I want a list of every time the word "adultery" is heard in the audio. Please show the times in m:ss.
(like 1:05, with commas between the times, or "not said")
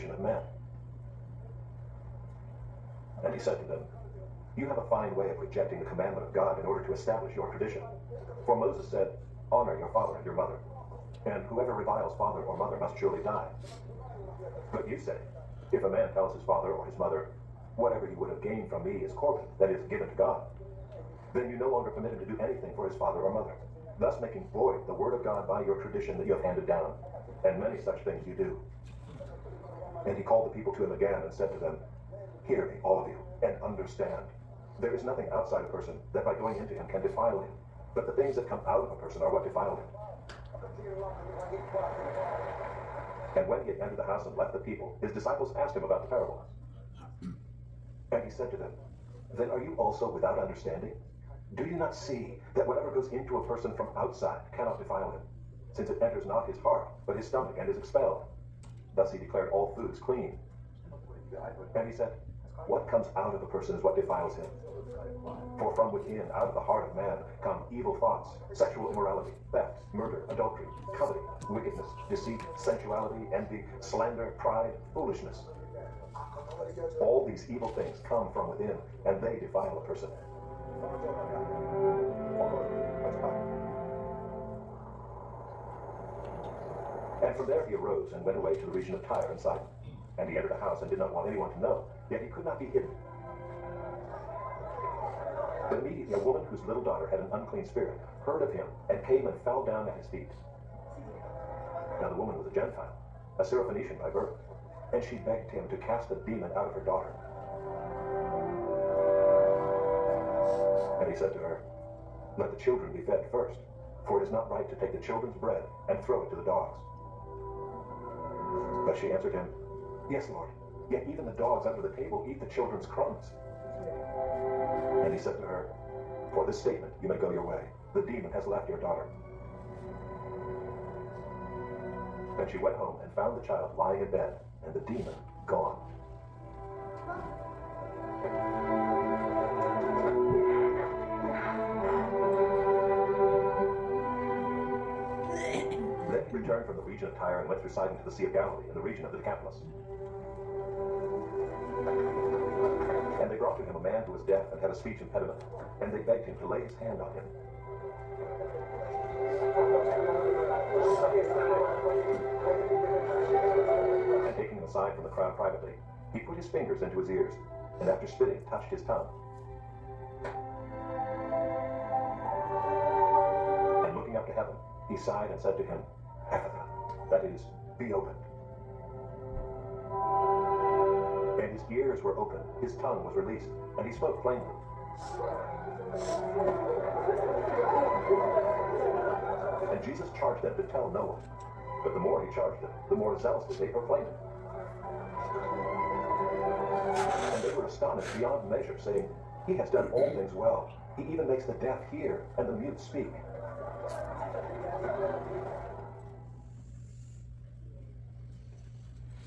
1:10.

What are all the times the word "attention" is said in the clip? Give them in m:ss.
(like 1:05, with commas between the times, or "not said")
not said.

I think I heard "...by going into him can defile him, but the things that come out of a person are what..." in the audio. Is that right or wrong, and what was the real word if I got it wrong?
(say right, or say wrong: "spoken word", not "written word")
right.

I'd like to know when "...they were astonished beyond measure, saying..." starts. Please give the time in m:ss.
3:17.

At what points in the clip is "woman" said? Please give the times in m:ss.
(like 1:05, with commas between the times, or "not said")
1:36, 1:42.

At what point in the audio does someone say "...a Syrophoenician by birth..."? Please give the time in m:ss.
1:43.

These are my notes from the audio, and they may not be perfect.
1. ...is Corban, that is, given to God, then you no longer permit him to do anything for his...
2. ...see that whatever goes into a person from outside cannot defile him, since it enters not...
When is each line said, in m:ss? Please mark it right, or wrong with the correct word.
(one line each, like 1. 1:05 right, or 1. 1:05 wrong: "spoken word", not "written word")
1. 0:19 right
2. 0:51 right.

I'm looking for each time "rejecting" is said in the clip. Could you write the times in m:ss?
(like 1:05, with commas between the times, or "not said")
0:05.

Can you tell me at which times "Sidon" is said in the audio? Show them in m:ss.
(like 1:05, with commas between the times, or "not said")
1:29, 2:27.